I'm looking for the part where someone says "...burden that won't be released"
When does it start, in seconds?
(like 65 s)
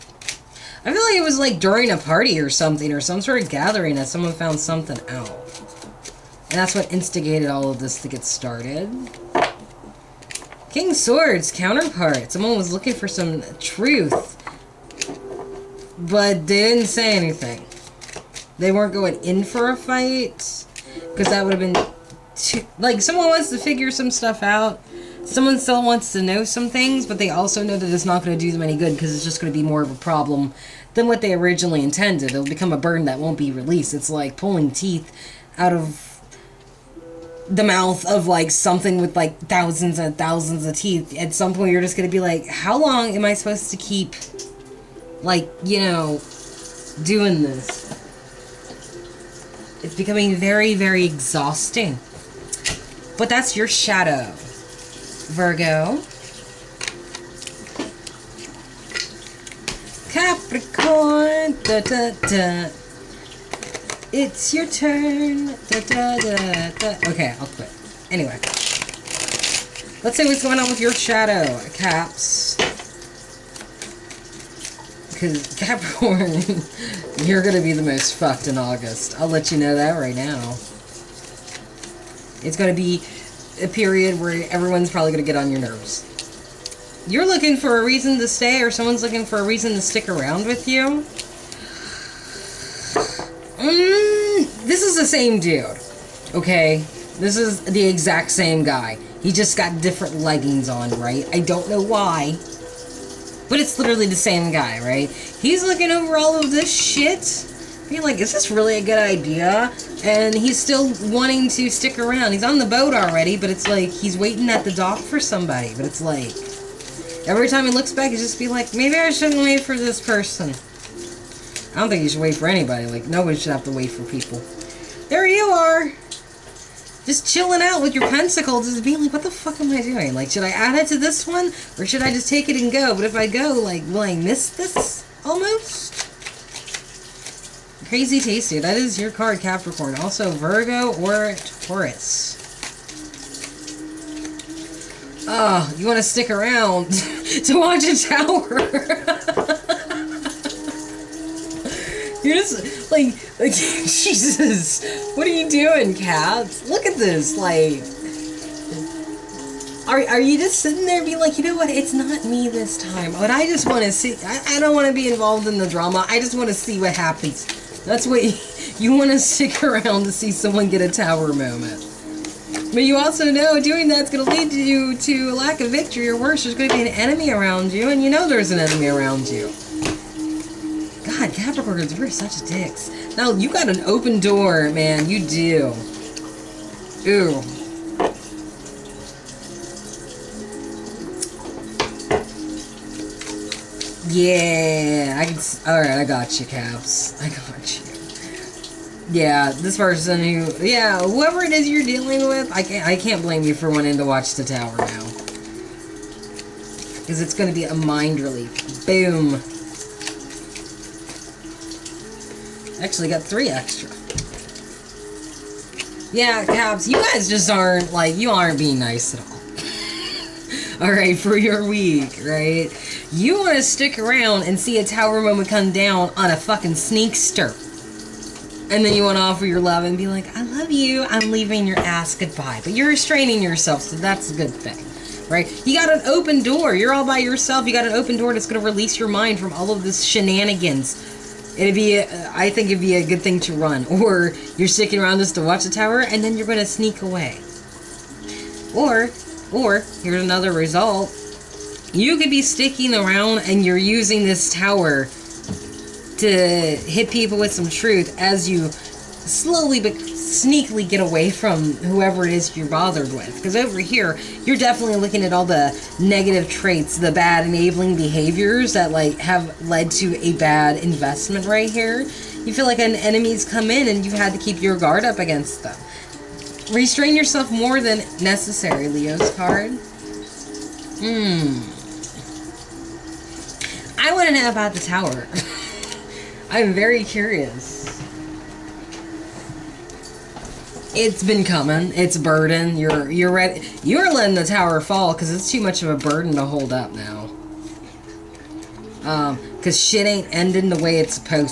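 32 s.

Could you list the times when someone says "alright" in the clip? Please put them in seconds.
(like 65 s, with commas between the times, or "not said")
195 s, 220 s.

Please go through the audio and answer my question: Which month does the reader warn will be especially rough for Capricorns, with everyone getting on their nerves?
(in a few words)
August.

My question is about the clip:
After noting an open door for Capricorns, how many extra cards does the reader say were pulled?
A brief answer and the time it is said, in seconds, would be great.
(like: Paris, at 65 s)
3, at 213 s.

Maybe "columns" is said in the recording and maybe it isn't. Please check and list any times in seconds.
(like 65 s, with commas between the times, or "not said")
not said.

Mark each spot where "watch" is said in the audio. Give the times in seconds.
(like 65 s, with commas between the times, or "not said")
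147 s, 204 s, 245 s.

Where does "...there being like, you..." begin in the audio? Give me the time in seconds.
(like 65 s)
160 s.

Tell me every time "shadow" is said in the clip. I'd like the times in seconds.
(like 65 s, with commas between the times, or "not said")
53 s, 70 s.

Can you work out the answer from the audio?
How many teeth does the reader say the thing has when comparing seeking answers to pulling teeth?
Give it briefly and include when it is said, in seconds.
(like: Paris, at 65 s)
Thousands and thousands, at 39 s.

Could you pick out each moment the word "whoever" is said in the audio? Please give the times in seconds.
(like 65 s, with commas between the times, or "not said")
200 s, 261 s.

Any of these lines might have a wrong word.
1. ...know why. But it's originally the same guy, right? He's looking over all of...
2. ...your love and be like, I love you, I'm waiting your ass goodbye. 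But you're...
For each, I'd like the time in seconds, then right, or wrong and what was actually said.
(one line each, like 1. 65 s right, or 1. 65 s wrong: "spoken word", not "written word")
1. 101 s wrong: "literally", not "originally"
2. 229 s wrong: "leaving", not "waiting".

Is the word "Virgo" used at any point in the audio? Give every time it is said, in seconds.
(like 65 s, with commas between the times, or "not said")
55 s, 140 s.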